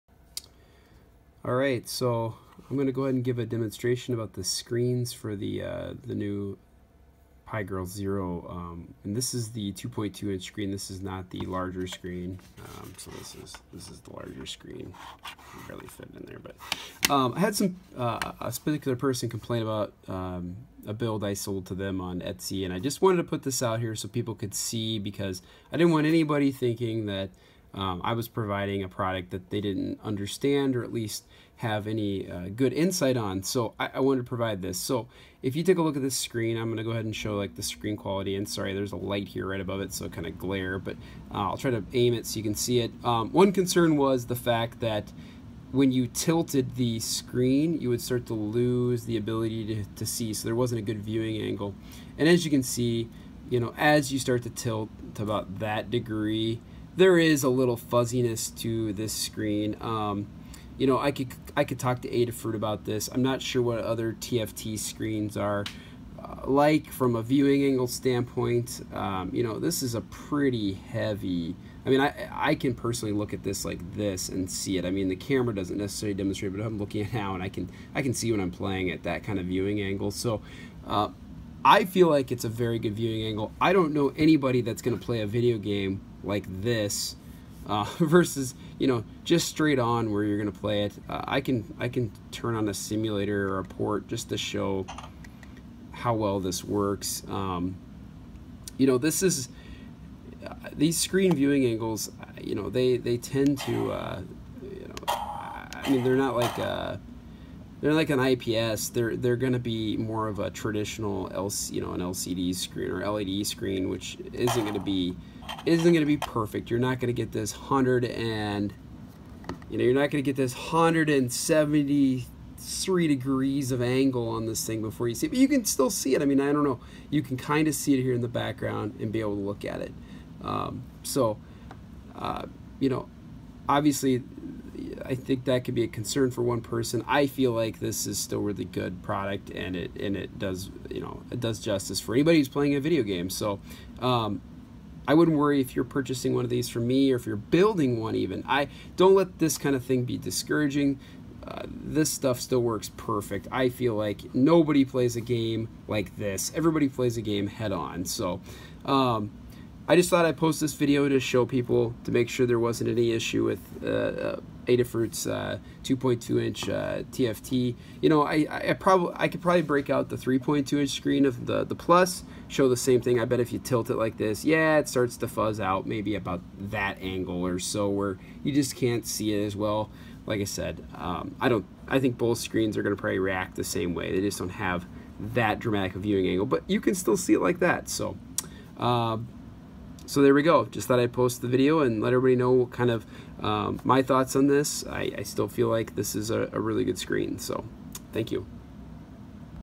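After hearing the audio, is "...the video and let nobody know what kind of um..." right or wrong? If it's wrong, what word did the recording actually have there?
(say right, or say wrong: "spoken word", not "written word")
wrong: "everybody", not "nobody".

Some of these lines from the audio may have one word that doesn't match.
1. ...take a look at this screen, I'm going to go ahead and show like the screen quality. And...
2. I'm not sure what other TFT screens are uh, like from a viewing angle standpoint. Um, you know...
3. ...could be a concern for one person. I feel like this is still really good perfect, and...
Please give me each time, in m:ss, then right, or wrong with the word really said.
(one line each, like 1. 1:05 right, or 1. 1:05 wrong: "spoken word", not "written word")
1. 0:35 right
2. 1:03 right
3. 2:15 wrong: "product", not "perfect".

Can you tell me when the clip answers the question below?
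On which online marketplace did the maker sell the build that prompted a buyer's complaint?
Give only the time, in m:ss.
0:22.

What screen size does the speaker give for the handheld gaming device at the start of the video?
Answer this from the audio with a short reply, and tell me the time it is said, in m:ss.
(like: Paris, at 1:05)
2.2 inch, at 0:09.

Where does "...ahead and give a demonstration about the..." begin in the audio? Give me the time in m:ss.
0:03.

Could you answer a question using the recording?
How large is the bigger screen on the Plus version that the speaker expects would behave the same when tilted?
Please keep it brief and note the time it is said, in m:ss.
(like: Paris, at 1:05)
3.2 inch, at 2:50.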